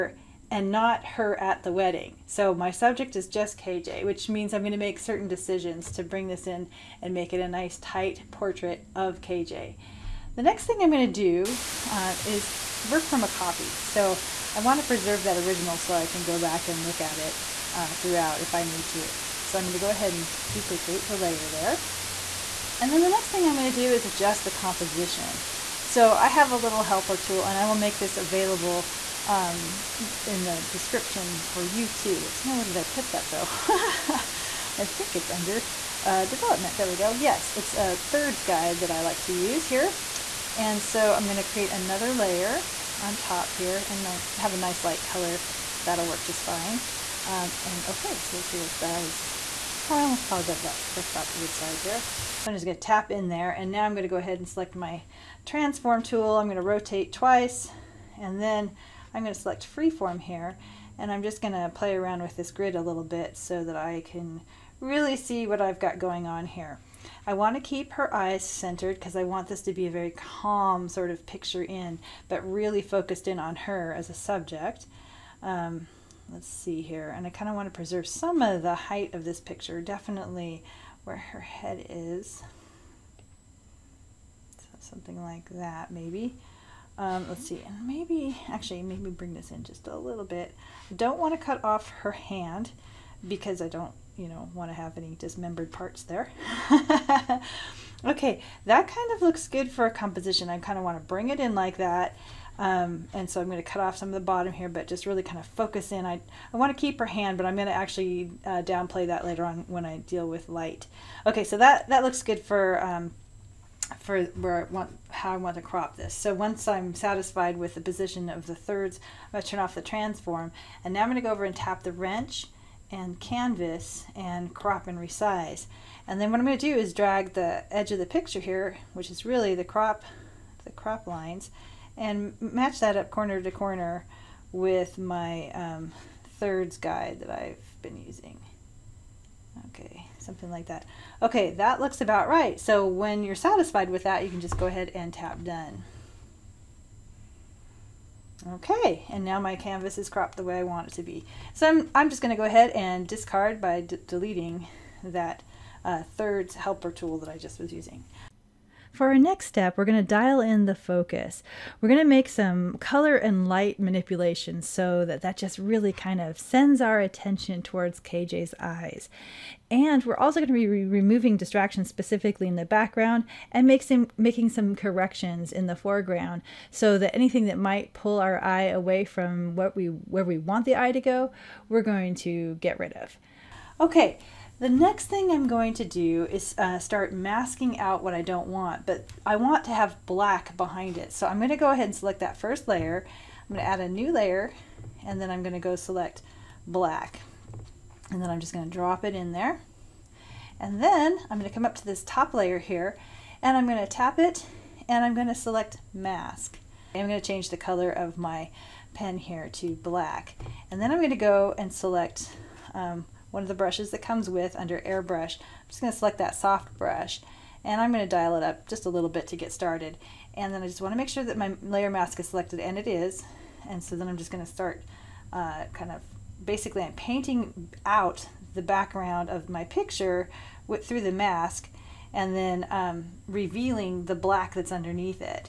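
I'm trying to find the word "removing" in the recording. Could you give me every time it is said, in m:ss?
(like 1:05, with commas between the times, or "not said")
2:50.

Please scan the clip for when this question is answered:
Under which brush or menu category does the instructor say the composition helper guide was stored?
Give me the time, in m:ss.
0:36.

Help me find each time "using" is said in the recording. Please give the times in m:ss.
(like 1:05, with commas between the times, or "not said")
2:18, 2:37.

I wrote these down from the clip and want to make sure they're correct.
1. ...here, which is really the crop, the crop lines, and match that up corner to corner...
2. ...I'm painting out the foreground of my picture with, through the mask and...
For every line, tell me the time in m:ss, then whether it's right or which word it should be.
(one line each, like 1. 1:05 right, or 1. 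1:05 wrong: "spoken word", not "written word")
1. 2:08 right
2. 3:46 wrong: "background", not "foreground".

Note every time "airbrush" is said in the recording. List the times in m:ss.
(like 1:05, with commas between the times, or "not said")
3:34.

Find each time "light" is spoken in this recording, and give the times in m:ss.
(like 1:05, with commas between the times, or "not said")
0:44, 1:50, 2:43.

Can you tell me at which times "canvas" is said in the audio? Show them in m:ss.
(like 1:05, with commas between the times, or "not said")
2:03, 2:29.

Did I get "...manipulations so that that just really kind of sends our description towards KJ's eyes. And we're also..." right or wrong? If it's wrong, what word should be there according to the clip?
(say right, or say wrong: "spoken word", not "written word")
wrong: "attention", not "description".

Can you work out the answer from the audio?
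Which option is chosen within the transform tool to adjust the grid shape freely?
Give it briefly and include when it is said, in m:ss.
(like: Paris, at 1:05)
freeform, at 0:59.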